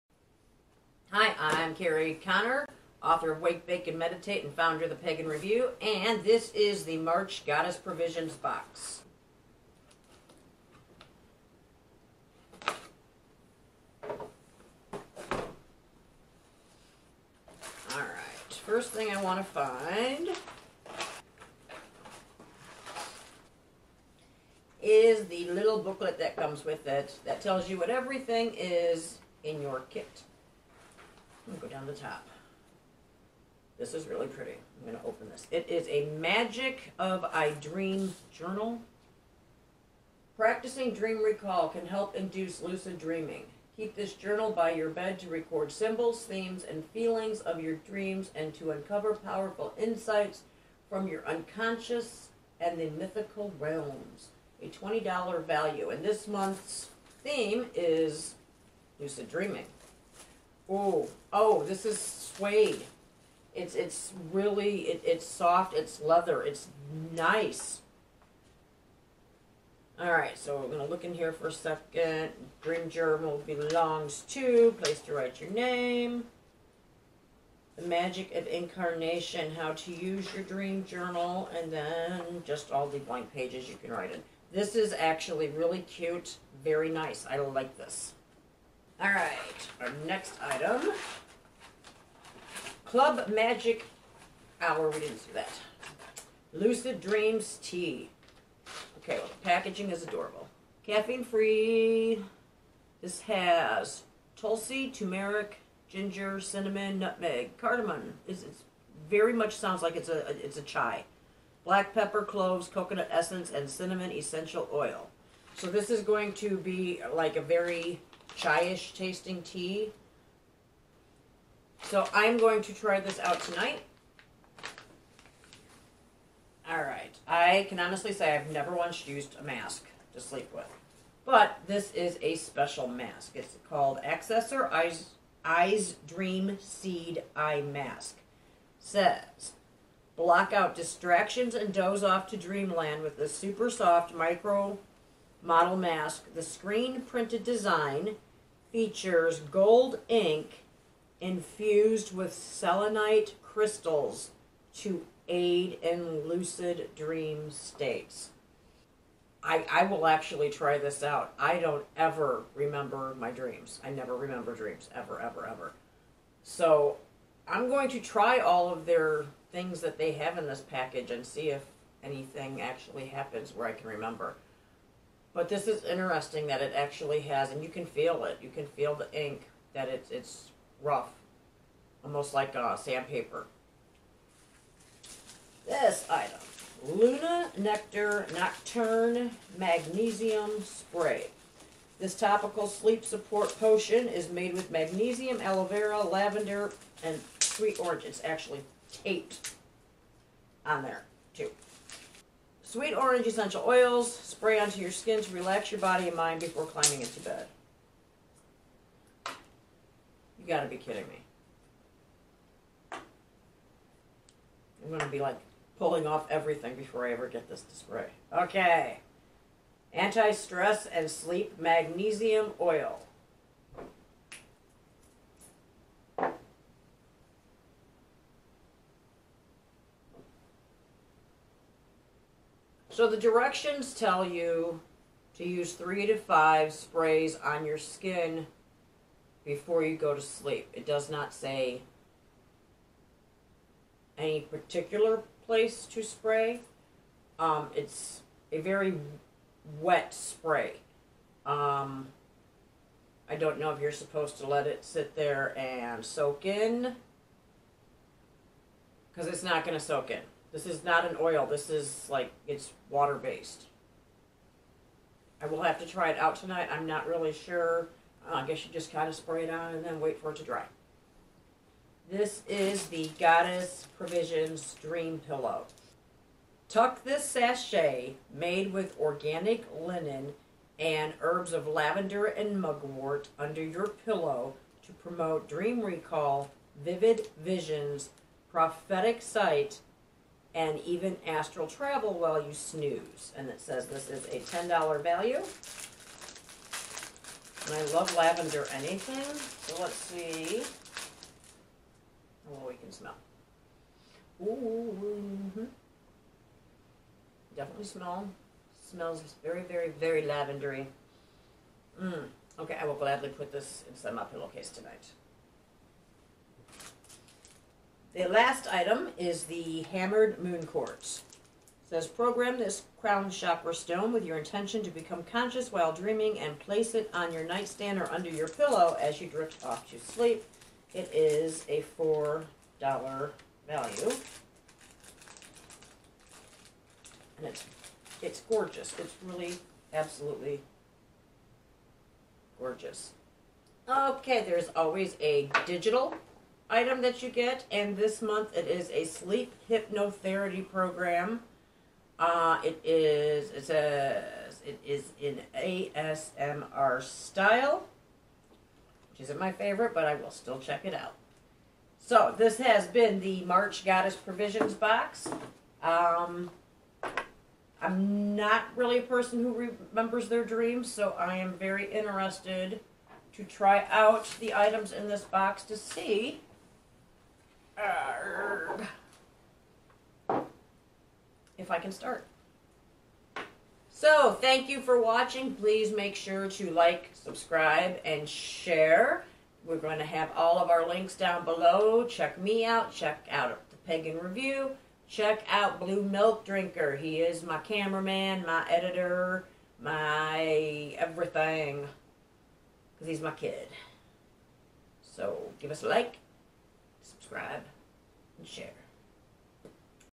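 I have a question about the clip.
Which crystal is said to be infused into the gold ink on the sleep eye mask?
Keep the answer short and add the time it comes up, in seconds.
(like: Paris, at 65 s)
selenite, at 152 s.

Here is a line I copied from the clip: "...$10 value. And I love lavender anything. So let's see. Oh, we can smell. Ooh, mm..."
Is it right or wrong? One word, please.
right.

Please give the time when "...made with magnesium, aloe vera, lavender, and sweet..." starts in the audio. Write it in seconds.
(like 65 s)
194 s.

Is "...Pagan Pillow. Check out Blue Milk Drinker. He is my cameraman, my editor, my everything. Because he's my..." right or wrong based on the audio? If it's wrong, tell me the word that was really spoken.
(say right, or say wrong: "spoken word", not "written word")
wrong: "Review", not "Pillow".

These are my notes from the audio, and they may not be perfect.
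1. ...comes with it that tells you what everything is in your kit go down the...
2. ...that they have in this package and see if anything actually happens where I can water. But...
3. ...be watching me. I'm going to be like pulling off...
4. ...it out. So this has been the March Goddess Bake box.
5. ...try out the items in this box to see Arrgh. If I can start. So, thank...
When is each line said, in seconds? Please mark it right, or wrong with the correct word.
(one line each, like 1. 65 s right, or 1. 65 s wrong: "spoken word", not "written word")
1. 26 s right
2. 169 s wrong: "remember", not "water"
3. 210 s wrong: "kidding", not "watching"
4. 360 s wrong: "Provisions", not "Bake"
5. 373 s right.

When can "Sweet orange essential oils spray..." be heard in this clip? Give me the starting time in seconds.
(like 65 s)
202 s.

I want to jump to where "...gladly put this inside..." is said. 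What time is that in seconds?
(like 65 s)
312 s.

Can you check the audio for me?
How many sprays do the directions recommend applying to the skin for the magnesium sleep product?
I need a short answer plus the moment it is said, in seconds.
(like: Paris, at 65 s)
3 to 5, at 235 s.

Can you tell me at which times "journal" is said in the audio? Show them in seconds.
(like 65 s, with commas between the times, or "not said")
38 s, 44 s, 72 s, 80 s.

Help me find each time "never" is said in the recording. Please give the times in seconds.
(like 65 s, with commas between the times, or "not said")
128 s, 163 s.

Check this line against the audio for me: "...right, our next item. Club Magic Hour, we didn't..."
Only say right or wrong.
right.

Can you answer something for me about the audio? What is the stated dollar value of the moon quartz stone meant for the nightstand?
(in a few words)
$4.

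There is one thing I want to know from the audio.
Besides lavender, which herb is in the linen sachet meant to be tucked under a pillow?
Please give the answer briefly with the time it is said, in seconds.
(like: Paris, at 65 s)
mugwort, at 282 s.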